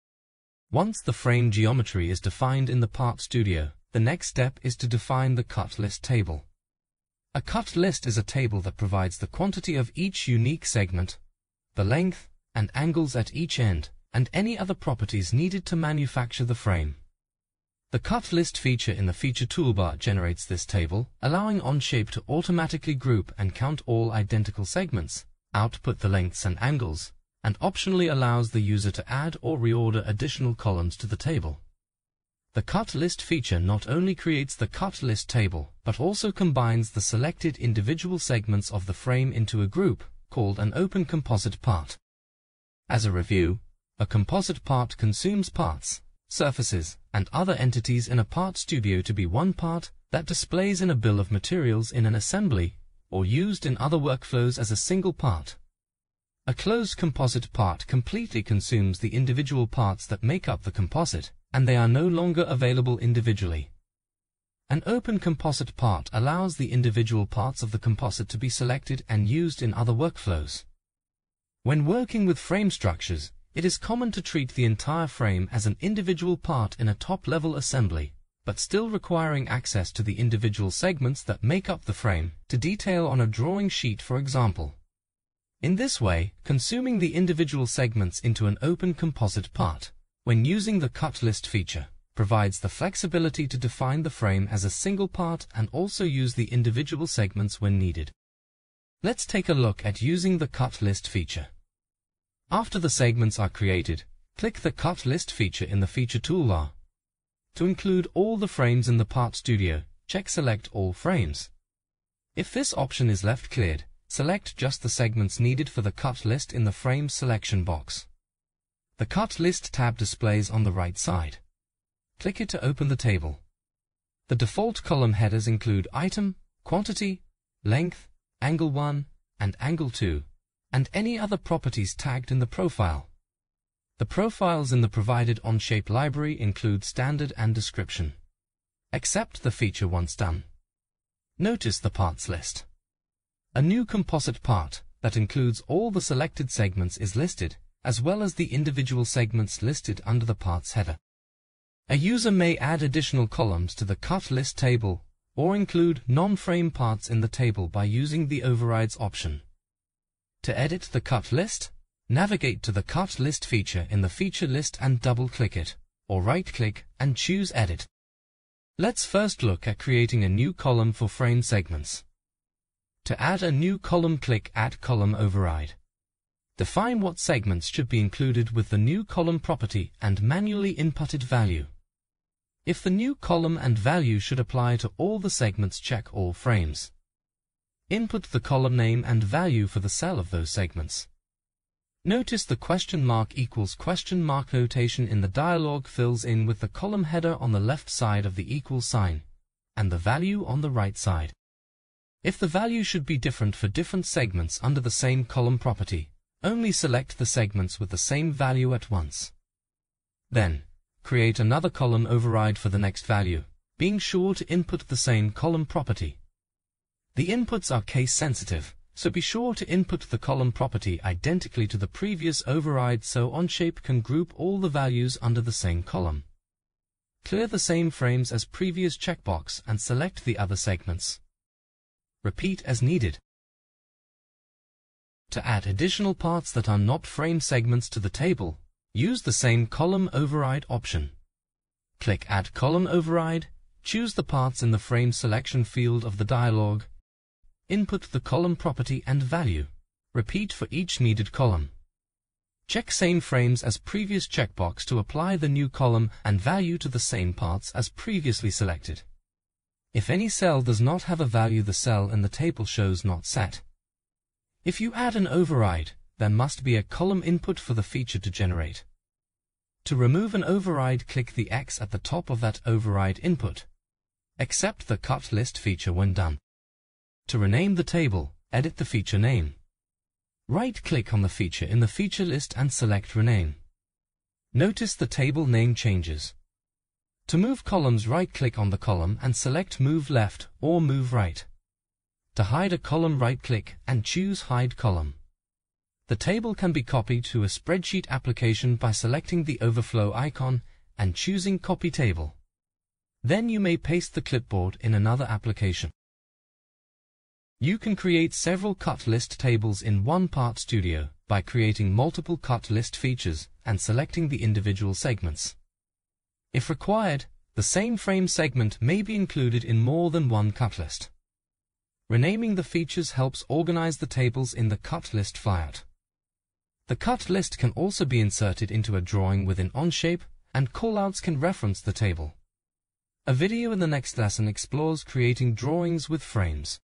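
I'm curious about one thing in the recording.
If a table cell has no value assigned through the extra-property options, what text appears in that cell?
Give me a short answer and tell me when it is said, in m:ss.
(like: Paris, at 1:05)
not set, at 4:23.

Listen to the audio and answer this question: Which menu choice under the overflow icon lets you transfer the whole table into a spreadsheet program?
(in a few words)
Copy Table.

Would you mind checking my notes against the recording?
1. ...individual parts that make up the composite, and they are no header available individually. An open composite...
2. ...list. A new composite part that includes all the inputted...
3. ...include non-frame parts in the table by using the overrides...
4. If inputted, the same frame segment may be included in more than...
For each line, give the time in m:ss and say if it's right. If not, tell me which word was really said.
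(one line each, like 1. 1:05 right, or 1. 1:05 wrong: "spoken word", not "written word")
1. 0:59 wrong: "longer", not "header"
2. 2:22 wrong: "selected", not "inputted"
3. 2:35 right
4. 5:16 wrong: "required", not "inputted".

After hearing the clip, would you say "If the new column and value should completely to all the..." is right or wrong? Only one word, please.
wrong.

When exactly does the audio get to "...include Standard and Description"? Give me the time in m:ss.
2:16.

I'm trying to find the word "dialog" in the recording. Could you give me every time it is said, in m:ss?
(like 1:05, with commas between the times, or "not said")
3:15, 4:06.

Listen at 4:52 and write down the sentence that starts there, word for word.
To hide a column right-click and choose Hide Column.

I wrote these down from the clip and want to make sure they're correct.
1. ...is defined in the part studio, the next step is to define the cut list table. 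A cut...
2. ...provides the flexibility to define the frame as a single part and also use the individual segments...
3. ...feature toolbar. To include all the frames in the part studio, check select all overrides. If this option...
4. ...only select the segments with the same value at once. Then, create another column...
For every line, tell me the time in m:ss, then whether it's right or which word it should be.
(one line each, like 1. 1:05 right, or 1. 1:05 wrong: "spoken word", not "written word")
1. 0:02 right
2. 1:32 right
3. 1:45 wrong: "frames", not "overrides"
4. 3:26 right.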